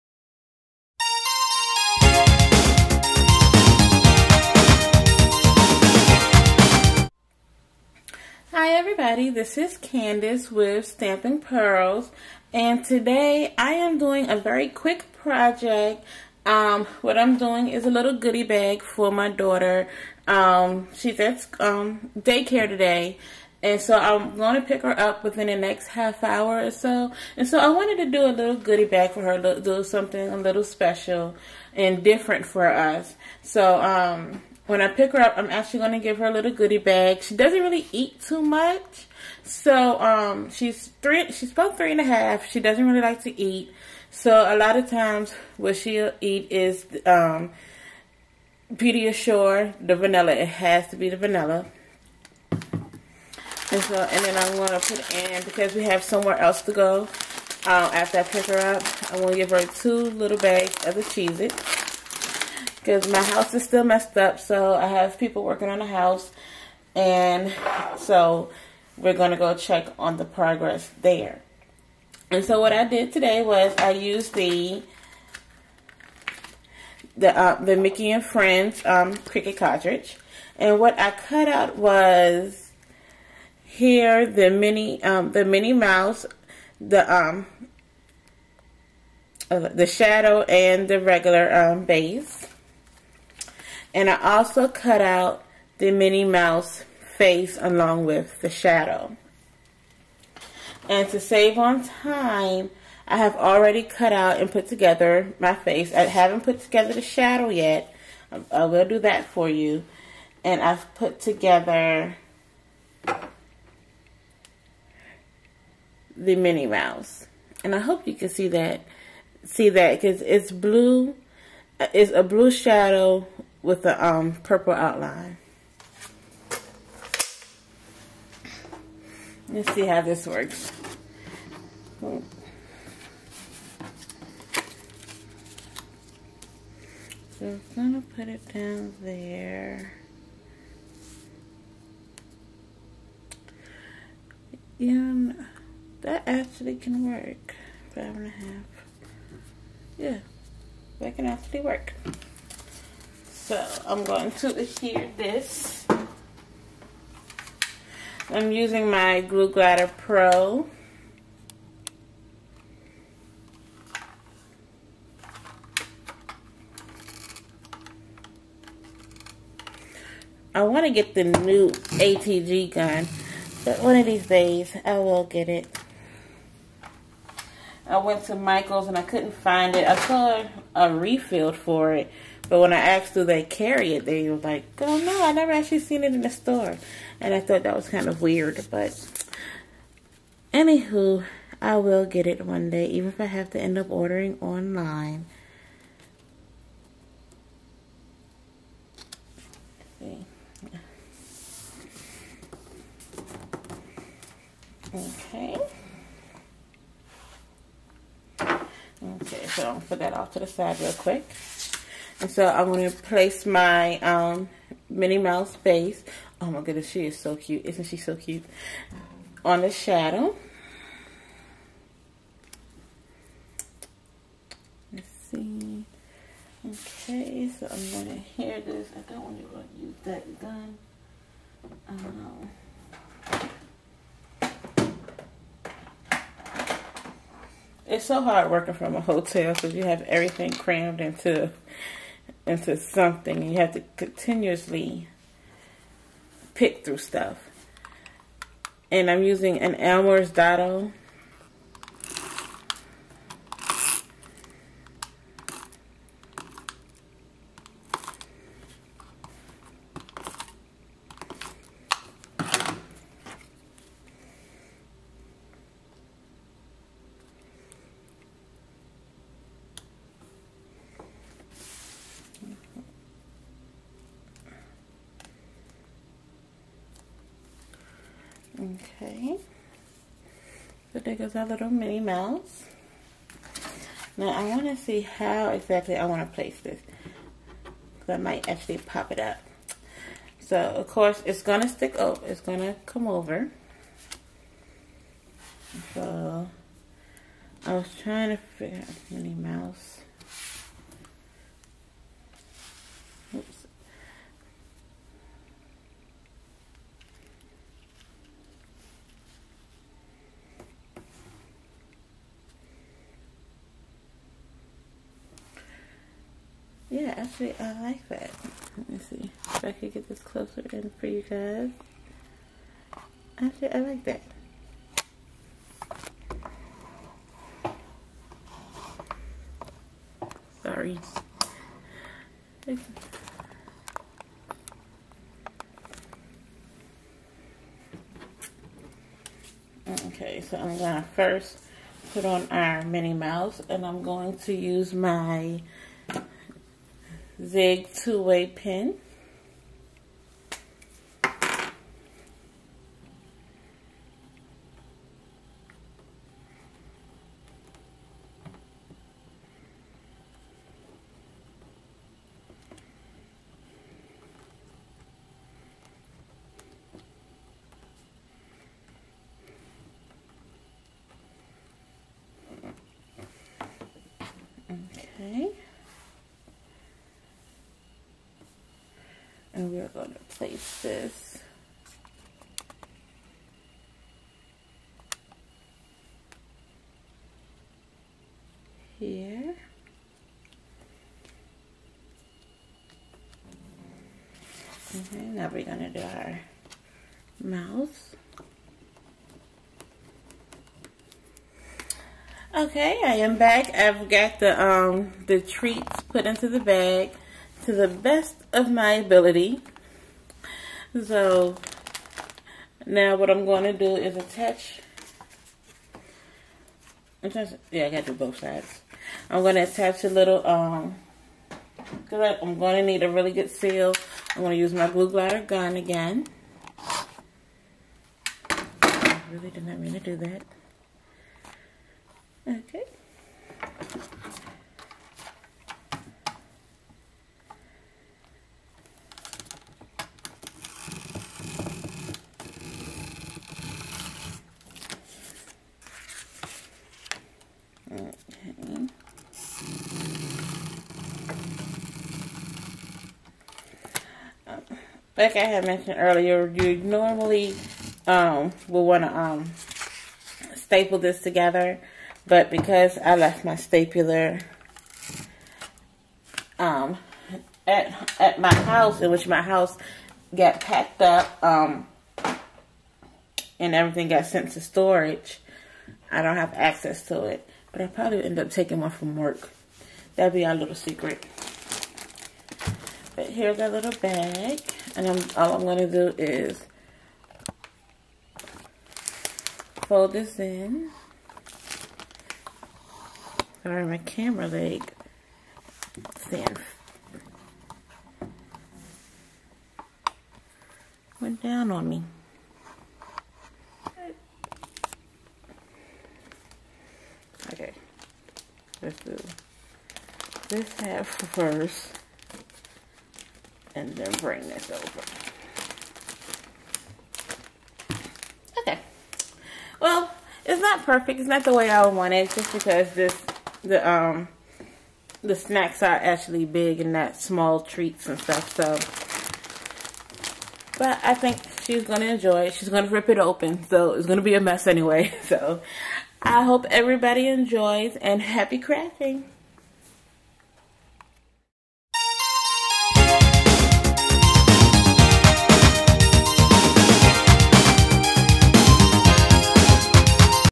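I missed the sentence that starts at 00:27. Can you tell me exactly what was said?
And so I wanted to do a little goodie bag for her, do something a little special and different for us.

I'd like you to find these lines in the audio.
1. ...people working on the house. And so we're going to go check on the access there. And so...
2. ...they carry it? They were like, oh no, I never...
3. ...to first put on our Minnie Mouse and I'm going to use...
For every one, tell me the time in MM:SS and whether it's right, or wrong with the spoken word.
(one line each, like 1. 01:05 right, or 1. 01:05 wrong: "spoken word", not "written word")
1. 01:05 wrong: "progress", not "access"
2. 03:03 right
3. 05:41 right.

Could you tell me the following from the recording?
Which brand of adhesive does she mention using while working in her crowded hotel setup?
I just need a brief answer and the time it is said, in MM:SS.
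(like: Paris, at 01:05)
Elmer's, at 04:09.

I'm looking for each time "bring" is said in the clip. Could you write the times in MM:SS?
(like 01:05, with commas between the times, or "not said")
08:34.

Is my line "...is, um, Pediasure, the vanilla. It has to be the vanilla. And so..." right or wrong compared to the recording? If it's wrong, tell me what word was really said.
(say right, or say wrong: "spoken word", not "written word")
right.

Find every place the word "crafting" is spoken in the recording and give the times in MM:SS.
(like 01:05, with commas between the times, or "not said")
08:58.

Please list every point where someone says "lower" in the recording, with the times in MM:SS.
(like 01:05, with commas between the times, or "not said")
not said.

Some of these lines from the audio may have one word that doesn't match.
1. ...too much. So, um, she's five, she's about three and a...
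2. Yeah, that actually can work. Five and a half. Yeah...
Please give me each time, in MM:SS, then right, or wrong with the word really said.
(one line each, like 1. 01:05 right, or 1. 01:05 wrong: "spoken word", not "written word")
1. 00:38 wrong: "three", not "five"
2. 02:24 right.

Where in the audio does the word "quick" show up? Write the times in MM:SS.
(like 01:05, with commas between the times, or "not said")
00:14, 03:30.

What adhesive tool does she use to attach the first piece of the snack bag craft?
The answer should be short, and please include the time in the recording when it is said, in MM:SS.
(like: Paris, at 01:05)
Glue Glider Pro, at 02:39.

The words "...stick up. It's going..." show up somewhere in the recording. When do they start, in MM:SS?
04:51.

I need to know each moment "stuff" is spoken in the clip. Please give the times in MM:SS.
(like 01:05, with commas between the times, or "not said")
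04:06, 08:48.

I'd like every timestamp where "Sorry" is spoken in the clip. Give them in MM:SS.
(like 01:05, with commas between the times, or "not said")
05:30, 08:13.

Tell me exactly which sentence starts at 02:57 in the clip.
I went to Michael's and I couldn't find it.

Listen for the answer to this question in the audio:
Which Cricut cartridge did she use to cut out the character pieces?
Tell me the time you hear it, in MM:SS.
01:17.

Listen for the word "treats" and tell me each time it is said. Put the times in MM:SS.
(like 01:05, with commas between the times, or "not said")
06:45, 08:47.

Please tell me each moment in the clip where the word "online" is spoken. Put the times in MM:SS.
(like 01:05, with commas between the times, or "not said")
03:14.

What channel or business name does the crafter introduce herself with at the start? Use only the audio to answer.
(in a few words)
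Stamping Pearls.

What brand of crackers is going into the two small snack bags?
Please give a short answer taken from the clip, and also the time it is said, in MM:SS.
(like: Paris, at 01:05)
Cheez-Its, at 01:01.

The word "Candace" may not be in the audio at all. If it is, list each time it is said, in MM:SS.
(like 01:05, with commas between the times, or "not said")
00:09.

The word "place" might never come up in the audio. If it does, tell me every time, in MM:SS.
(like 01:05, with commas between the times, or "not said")
03:32, 04:46, 06:20.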